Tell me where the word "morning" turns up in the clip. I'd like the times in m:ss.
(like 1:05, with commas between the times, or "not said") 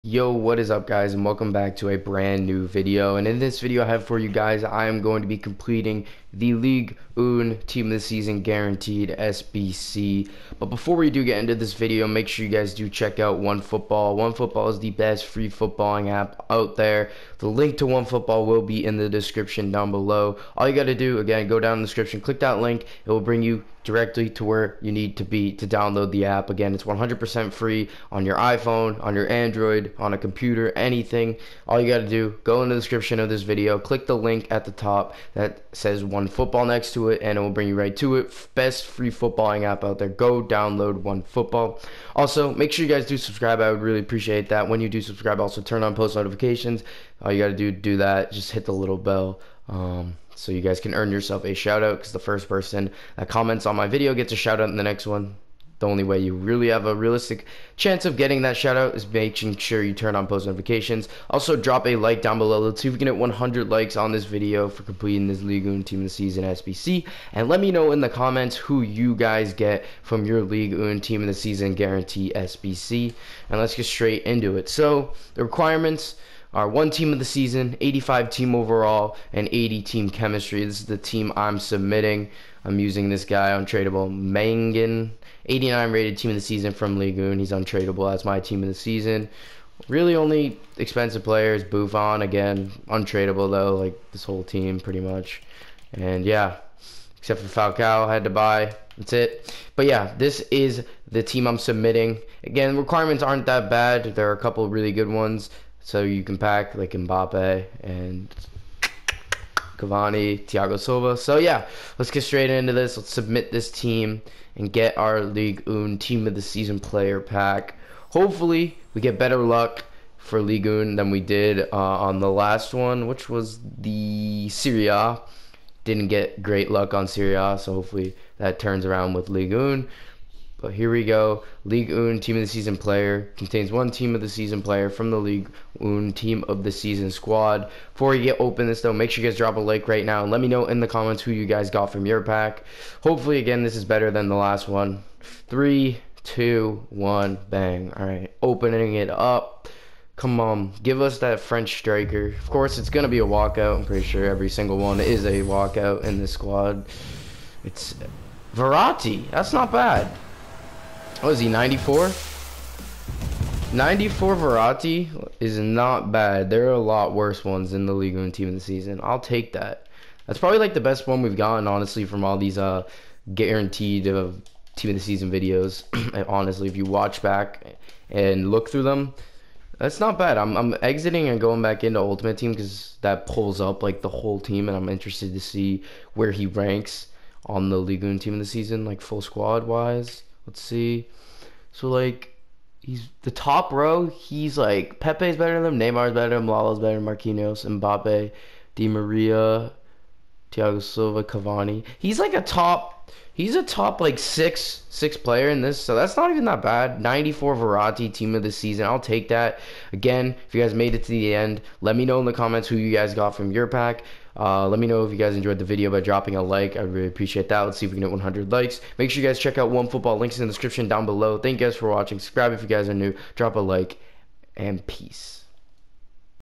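not said.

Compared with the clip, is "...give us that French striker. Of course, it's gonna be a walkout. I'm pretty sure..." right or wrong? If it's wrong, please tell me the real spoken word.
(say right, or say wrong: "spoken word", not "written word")
right.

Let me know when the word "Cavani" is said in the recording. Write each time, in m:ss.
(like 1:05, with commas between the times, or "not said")
1:49, 3:21.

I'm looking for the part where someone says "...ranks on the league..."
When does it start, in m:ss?
3:06.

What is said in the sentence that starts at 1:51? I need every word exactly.
So yeah, let's get straight into this.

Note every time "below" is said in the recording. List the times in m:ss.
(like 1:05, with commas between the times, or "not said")
0:19, 1:02, 3:41.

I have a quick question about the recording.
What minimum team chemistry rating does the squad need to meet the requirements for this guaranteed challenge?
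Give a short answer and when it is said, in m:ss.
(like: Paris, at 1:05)
80, at 1:19.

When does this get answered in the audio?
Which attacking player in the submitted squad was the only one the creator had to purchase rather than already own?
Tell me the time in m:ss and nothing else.
1:37.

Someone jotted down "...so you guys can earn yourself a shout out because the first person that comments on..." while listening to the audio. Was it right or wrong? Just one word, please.
right.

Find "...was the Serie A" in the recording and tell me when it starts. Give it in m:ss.
2:03.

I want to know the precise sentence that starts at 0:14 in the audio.
OneFootball is the best free footballing app out there.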